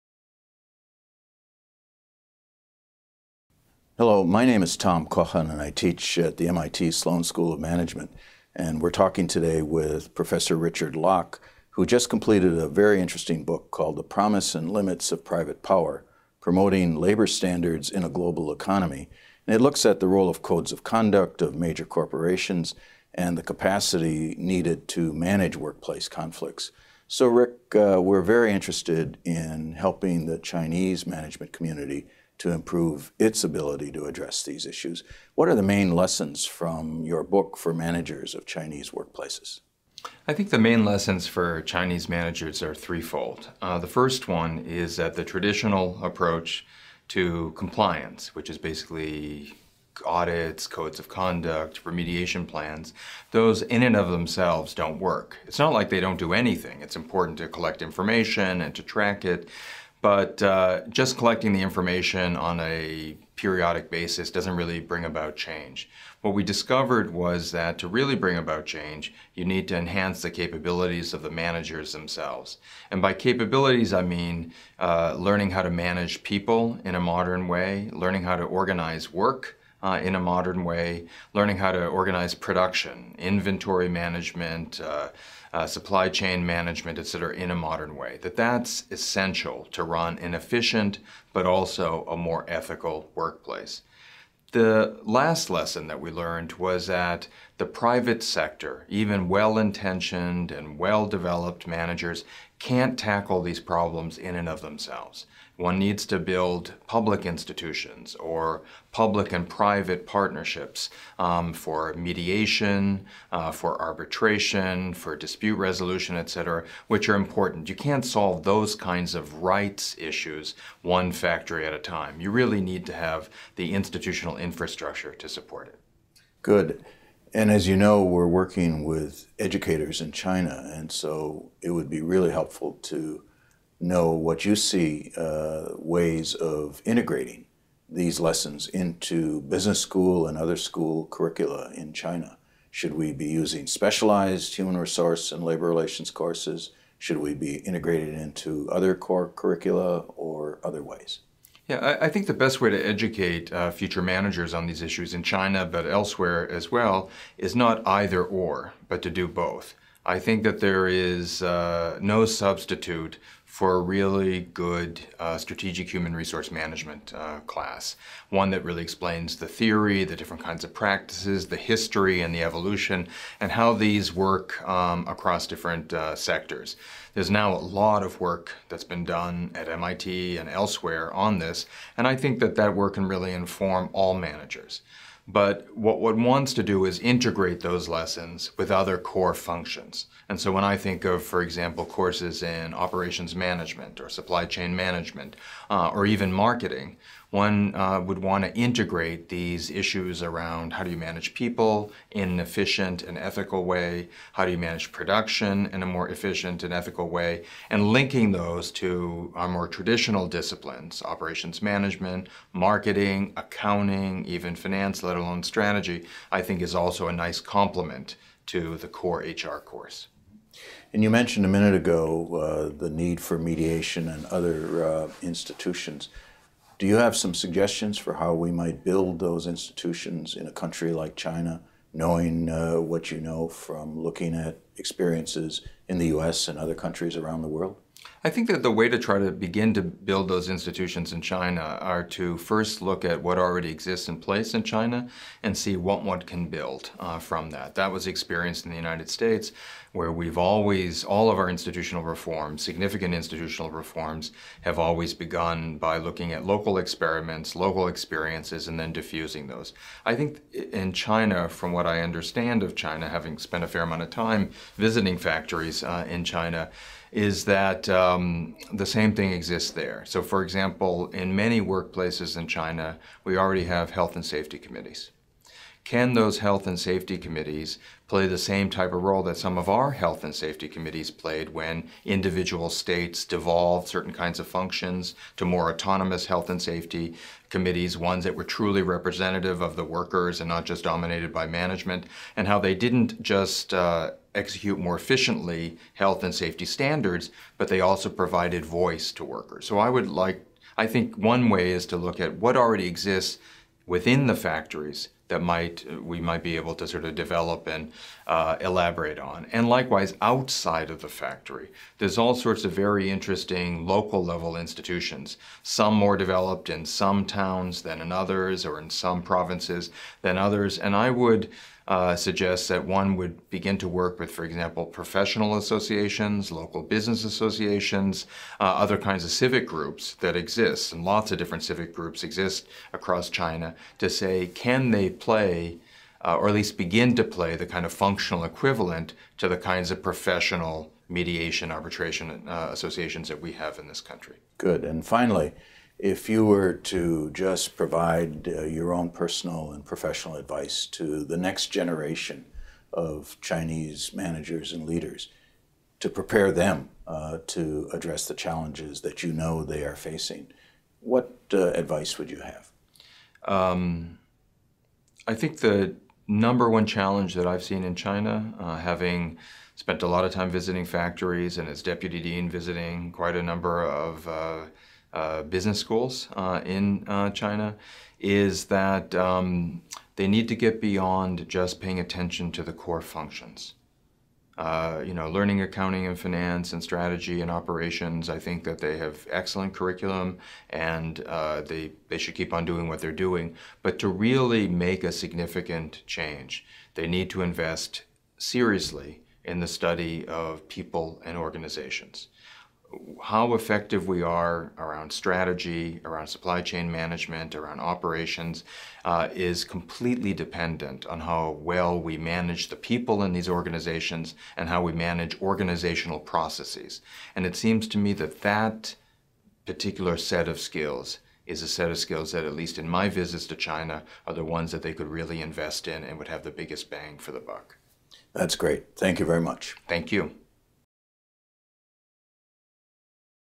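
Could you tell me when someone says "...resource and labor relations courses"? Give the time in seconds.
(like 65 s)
144 s.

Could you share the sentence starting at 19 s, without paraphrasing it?
And it looks at the role of codes of conduct of major corporations and the capacity needed to manage workplace conflicts.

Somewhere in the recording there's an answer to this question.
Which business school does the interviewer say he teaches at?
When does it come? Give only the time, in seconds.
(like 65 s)
6 s.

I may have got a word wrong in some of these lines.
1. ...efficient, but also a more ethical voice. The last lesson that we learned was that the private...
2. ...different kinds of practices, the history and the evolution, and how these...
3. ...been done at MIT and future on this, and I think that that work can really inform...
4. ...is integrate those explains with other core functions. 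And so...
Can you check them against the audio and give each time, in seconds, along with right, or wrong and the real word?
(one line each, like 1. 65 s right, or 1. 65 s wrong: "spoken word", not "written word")
1. 90 s wrong: "workplace", not "voice"
2. 170 s right
3. 178 s wrong: "elsewhere", not "future"
4. 186 s wrong: "lessons", not "explains".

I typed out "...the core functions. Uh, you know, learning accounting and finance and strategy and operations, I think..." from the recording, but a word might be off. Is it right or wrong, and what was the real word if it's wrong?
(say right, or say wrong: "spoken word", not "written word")
right.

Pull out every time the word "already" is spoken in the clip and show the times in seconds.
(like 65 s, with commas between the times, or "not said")
243 s, 273 s, 302 s.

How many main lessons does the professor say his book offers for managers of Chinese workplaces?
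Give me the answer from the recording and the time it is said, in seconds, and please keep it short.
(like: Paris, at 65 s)
3, at 42 s.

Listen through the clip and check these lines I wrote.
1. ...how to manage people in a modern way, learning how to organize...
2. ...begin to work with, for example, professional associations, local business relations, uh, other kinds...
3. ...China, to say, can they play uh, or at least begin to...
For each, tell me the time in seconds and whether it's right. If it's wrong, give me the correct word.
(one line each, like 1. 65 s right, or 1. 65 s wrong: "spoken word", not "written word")
1. 75 s right
2. 323 s wrong: "associations", not "relations"
3. 333 s right.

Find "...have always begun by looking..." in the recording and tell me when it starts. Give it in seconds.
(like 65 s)
254 s.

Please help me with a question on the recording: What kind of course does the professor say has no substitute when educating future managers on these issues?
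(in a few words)
Strategic human resource management.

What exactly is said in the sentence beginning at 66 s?
What we discovered was that to really bring about change, you need to enhance the capabilities of the managers themselves.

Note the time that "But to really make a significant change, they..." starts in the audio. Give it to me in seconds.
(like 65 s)
393 s.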